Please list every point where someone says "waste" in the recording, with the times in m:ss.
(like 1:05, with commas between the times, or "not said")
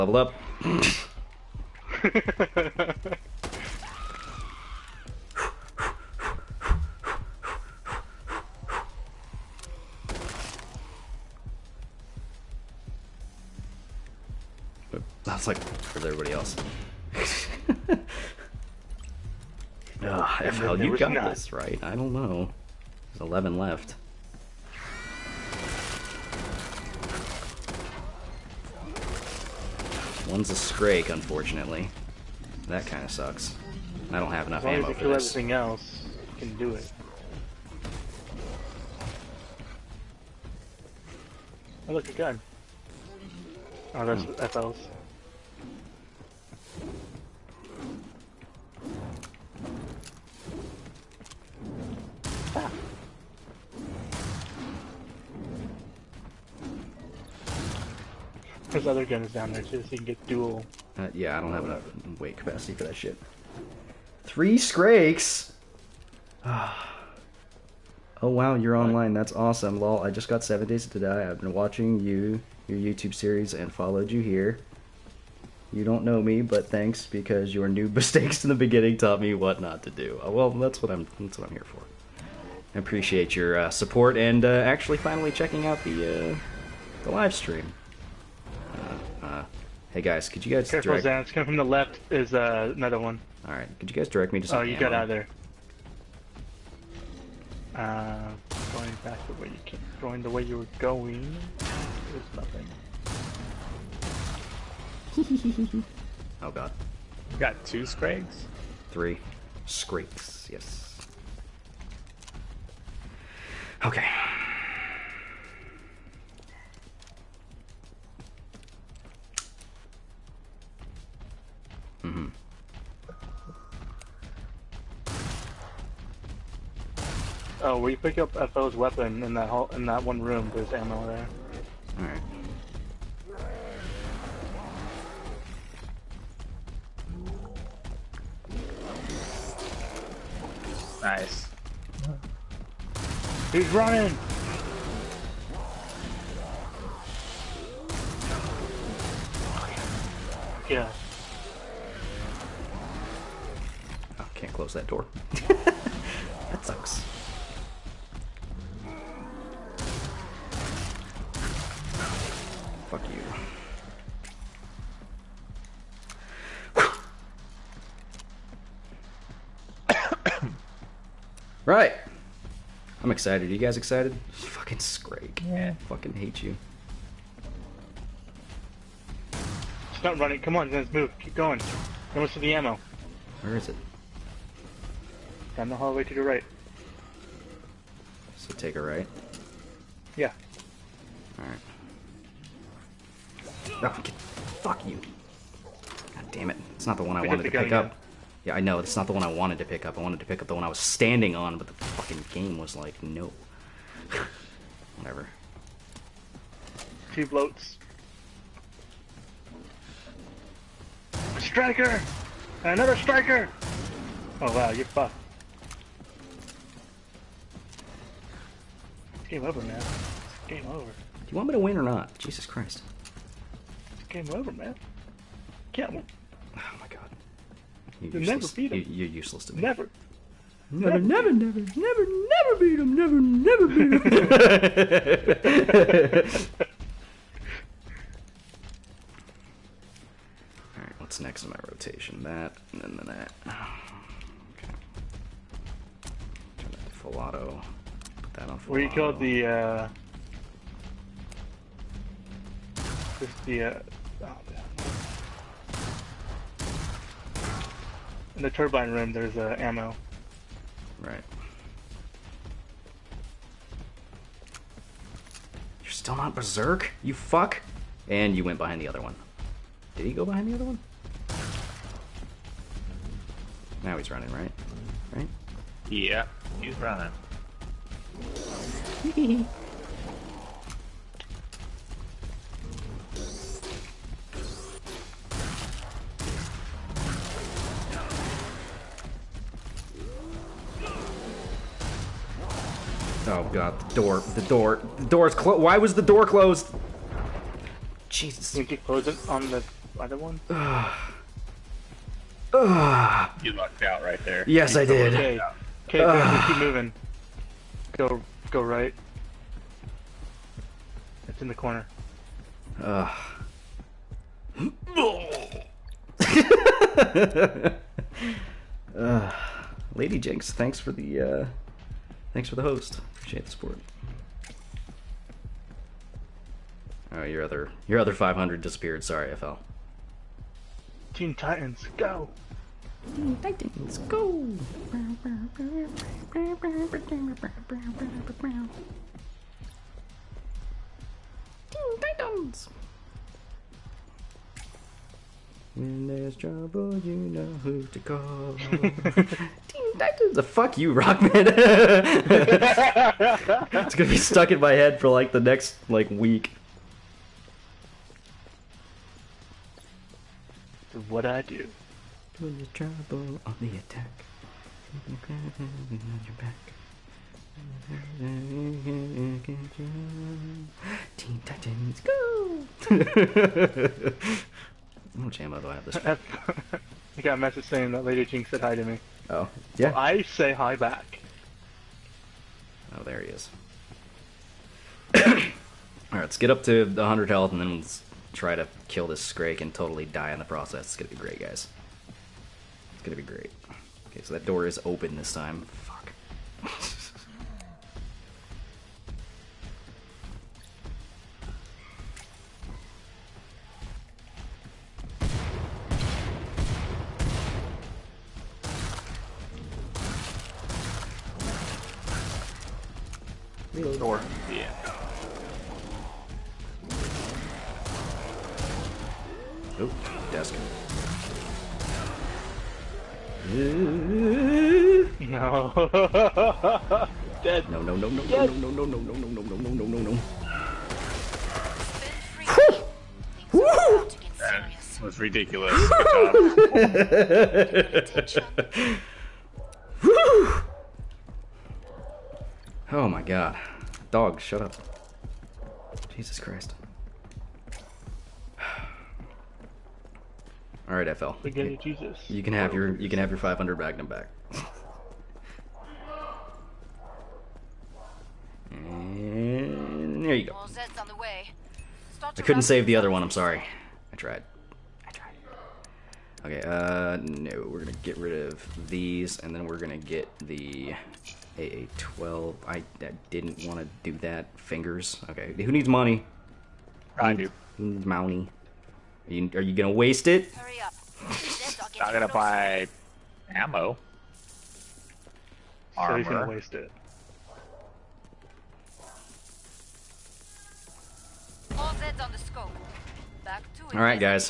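7:59, 8:06.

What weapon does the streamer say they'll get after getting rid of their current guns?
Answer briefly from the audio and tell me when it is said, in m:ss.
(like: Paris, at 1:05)
AA-12, at 7:49.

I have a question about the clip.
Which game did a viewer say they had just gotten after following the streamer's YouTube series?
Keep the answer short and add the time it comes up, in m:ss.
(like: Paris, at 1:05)
Seven Days to Die, at 1:10.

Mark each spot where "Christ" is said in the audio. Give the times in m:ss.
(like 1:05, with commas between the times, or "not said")
3:42, 7:26.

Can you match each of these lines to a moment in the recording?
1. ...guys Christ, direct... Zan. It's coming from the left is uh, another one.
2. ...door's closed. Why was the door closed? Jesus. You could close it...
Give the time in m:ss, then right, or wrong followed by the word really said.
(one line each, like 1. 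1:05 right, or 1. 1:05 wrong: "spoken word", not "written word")
1. 1:30 wrong: "Careful", not "Christ"
2. 4:55 right.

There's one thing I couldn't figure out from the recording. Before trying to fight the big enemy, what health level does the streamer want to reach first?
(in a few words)
100.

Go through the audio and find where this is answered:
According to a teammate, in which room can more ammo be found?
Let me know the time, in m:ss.
4:18.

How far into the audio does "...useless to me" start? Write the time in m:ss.
3:49.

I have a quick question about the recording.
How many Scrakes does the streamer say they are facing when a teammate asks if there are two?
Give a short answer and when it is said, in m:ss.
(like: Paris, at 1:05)
3, at 1:48.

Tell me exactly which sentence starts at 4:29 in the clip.
Did he go behind the other one?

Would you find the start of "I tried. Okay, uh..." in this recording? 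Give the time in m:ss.
7:45.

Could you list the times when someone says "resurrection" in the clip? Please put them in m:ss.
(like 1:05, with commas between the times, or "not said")
not said.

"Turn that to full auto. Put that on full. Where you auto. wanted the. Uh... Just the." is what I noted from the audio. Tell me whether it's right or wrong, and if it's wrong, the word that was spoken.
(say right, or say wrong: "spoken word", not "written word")
wrong: "killed", not "wanted".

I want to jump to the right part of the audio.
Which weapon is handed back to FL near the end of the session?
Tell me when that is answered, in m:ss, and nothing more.
7:32.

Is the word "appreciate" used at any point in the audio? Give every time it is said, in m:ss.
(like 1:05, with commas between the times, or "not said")
1:22, 5:23.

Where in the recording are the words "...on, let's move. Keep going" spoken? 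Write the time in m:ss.
3:00.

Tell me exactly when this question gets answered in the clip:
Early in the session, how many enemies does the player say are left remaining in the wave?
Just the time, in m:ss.
0:23.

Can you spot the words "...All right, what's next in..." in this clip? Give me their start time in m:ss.
4:00.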